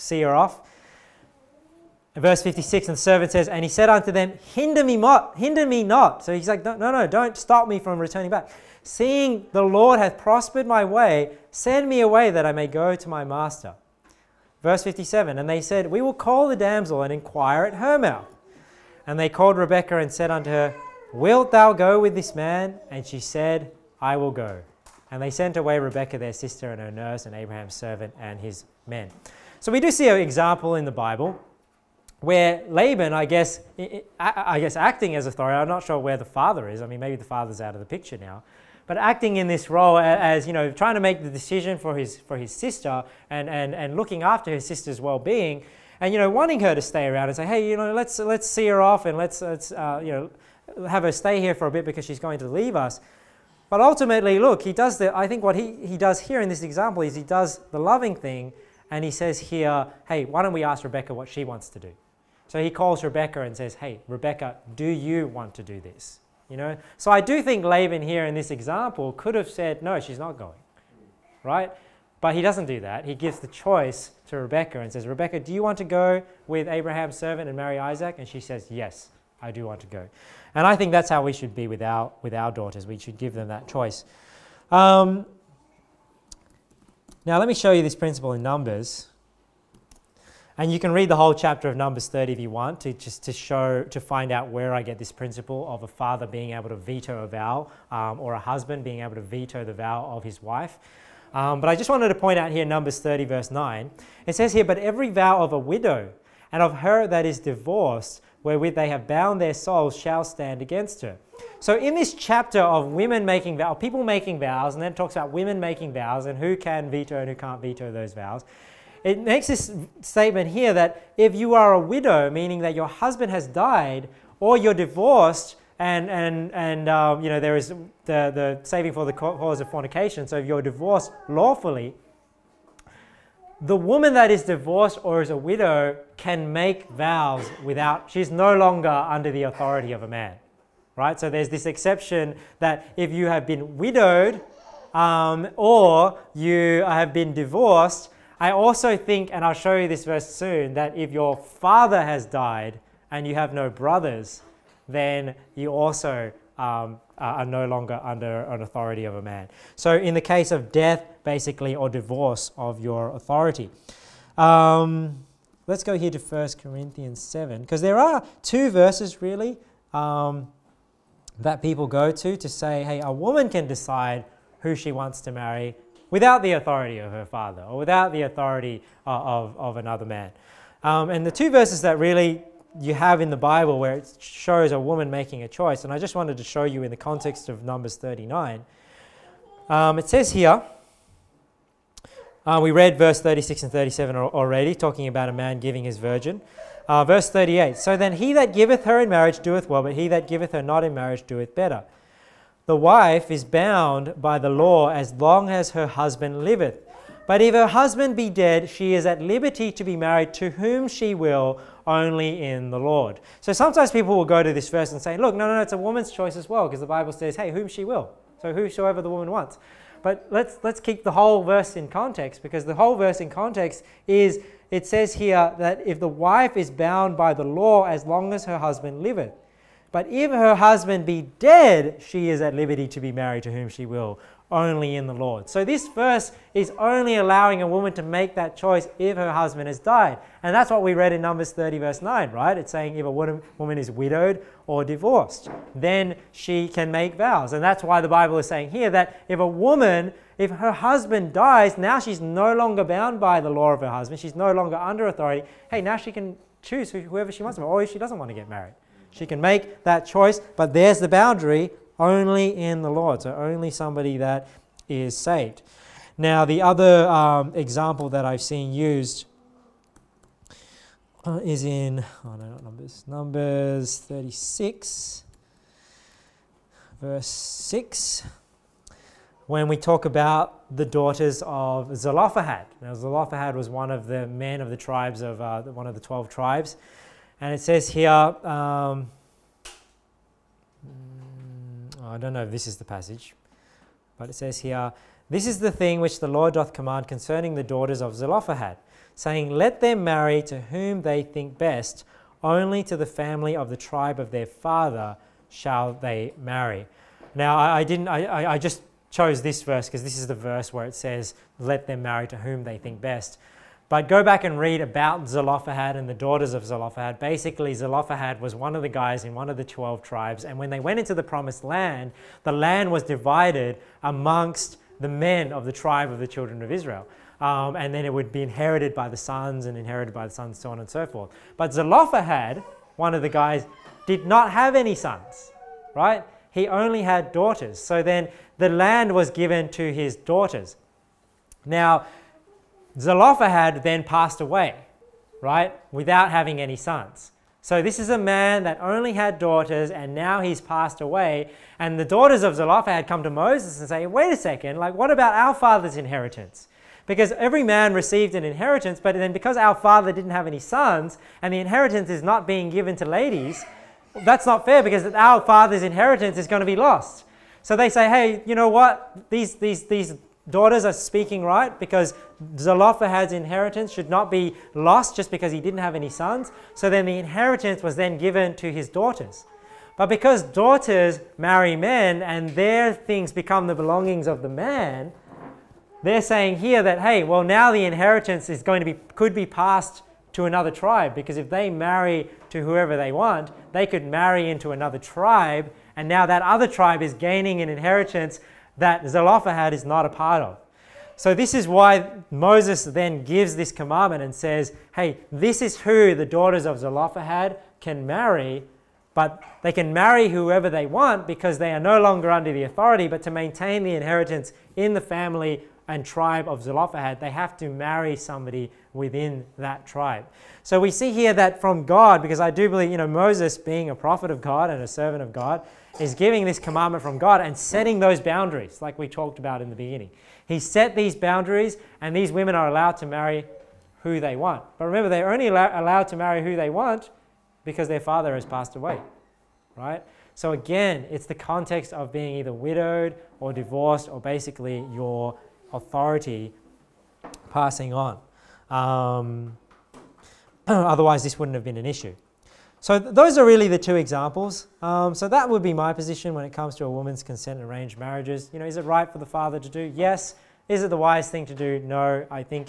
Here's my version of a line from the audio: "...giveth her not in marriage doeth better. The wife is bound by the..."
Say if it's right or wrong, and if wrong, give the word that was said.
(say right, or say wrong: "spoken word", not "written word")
right.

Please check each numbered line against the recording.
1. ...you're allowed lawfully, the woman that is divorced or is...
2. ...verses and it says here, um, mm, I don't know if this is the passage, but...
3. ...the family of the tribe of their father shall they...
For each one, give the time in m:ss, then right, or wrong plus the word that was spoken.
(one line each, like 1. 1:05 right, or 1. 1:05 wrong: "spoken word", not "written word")
1. 2:10 wrong: "divorced", not "allowed"
2. 4:46 wrong: "tribes", not "verses"
3. 5:02 right.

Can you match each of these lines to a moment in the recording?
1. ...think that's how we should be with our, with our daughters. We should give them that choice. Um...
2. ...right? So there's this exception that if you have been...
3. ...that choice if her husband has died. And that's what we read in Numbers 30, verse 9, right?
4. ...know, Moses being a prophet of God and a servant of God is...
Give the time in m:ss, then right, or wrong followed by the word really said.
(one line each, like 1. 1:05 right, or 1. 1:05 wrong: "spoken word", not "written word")
1. 1:20 right
2. 2:20 right
3. 3:58 right
4. 7:02 right.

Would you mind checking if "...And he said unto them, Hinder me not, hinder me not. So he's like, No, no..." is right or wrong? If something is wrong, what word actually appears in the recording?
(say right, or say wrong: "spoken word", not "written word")
right.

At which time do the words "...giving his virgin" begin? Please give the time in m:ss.
3:15.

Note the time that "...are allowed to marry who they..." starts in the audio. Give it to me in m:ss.
7:12.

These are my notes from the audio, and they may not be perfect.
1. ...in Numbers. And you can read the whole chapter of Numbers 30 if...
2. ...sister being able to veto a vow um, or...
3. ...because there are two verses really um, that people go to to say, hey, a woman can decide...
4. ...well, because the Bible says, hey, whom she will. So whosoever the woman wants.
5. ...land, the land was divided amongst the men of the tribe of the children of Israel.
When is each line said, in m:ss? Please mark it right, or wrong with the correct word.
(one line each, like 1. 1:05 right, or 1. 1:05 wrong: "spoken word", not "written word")
1. 1:28 right
2. 1:35 wrong: "father", not "sister"
3. 2:47 right
4. 3:36 right
5. 5:21 right.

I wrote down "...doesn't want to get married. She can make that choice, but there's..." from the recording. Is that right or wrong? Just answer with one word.
right.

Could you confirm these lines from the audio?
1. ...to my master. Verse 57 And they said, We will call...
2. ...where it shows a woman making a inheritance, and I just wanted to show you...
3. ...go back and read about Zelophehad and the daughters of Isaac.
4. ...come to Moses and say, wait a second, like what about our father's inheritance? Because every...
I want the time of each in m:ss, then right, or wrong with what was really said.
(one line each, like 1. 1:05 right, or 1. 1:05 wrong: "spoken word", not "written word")
1. 0:12 right
2. 3:03 wrong: "choice", not "inheritance"
3. 5:14 wrong: "Zelophehad", not "Isaac"
4. 5:53 right.